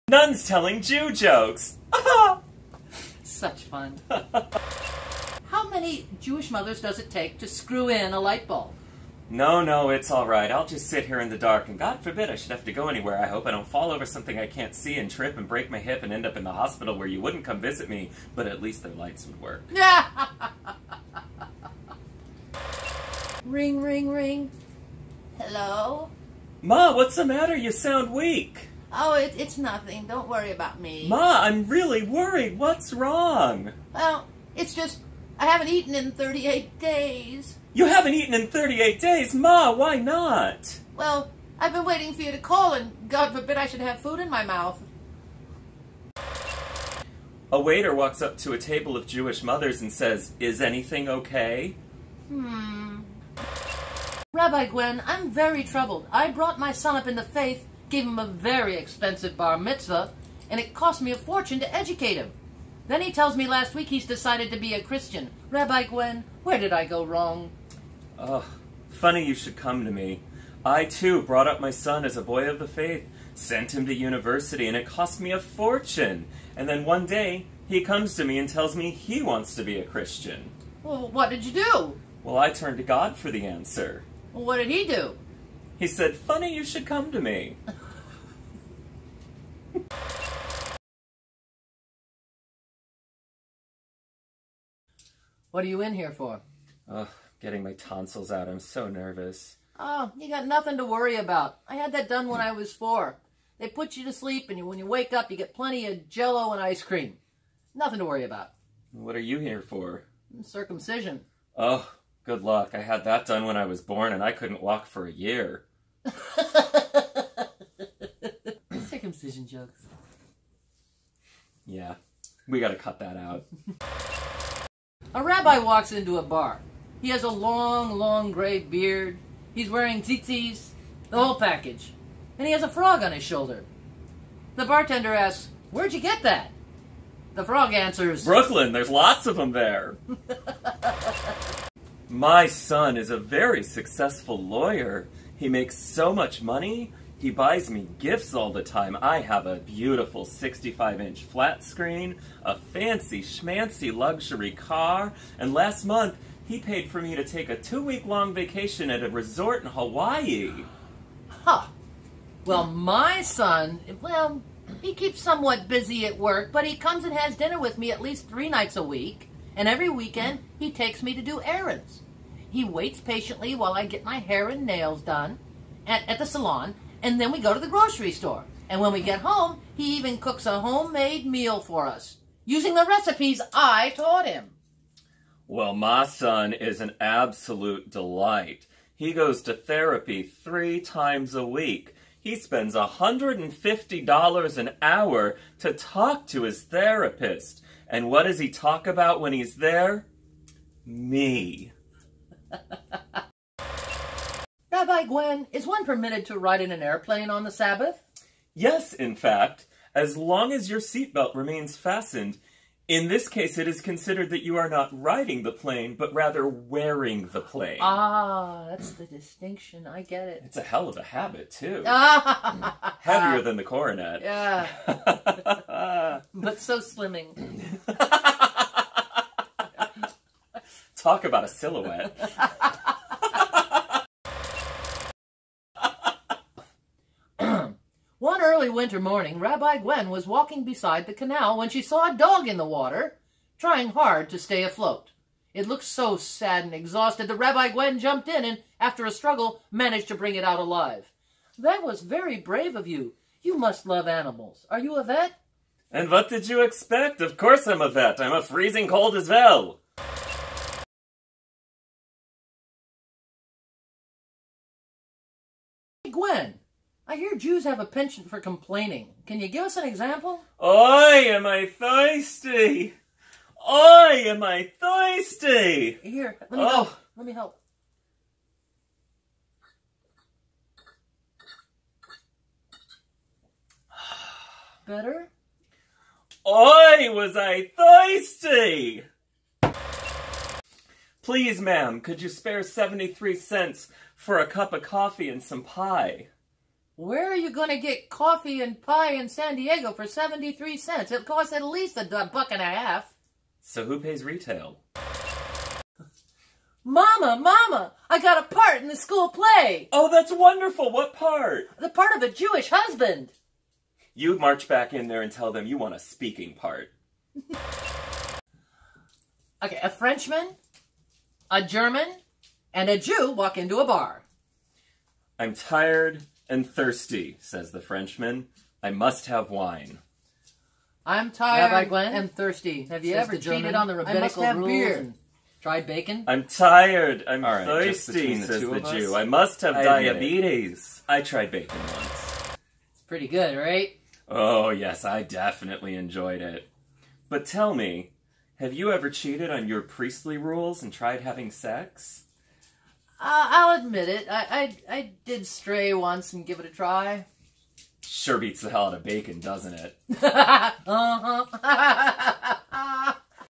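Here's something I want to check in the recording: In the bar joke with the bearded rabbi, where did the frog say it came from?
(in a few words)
Brooklyn.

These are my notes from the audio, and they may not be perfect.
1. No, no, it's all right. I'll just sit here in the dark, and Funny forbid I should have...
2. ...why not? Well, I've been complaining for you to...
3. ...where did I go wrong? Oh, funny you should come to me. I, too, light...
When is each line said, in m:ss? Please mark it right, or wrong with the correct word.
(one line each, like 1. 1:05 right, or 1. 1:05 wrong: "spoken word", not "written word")
1. 0:09 wrong: "God", not "Funny"
2. 0:39 wrong: "waiting", not "complaining"
3. 1:06 wrong: "brought", not "light".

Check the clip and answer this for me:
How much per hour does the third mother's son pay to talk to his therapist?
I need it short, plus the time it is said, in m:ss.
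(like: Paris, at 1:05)
$150, at 3:12.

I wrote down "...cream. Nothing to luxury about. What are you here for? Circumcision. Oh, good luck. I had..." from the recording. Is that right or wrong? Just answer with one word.
wrong.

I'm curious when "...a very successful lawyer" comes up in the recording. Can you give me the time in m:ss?
2:23.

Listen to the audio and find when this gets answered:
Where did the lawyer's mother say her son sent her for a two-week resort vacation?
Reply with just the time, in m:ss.
2:39.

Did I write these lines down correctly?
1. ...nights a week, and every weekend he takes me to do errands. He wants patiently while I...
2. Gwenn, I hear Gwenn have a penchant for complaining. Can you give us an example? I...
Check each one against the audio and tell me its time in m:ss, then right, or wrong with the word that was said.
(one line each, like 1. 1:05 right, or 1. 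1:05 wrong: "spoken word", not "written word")
1. 2:48 wrong: "waits", not "wants"
2. 4:26 wrong: "Jews", not "Gwenn".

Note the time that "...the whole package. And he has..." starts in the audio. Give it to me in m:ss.
2:11.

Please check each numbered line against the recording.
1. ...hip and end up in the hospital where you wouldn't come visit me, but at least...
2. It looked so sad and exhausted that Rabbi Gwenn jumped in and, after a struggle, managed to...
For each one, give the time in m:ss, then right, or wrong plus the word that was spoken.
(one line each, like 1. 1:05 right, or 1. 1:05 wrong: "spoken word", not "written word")
1. 0:15 right
2. 4:05 right.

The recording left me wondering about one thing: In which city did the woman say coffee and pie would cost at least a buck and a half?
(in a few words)
San Diego.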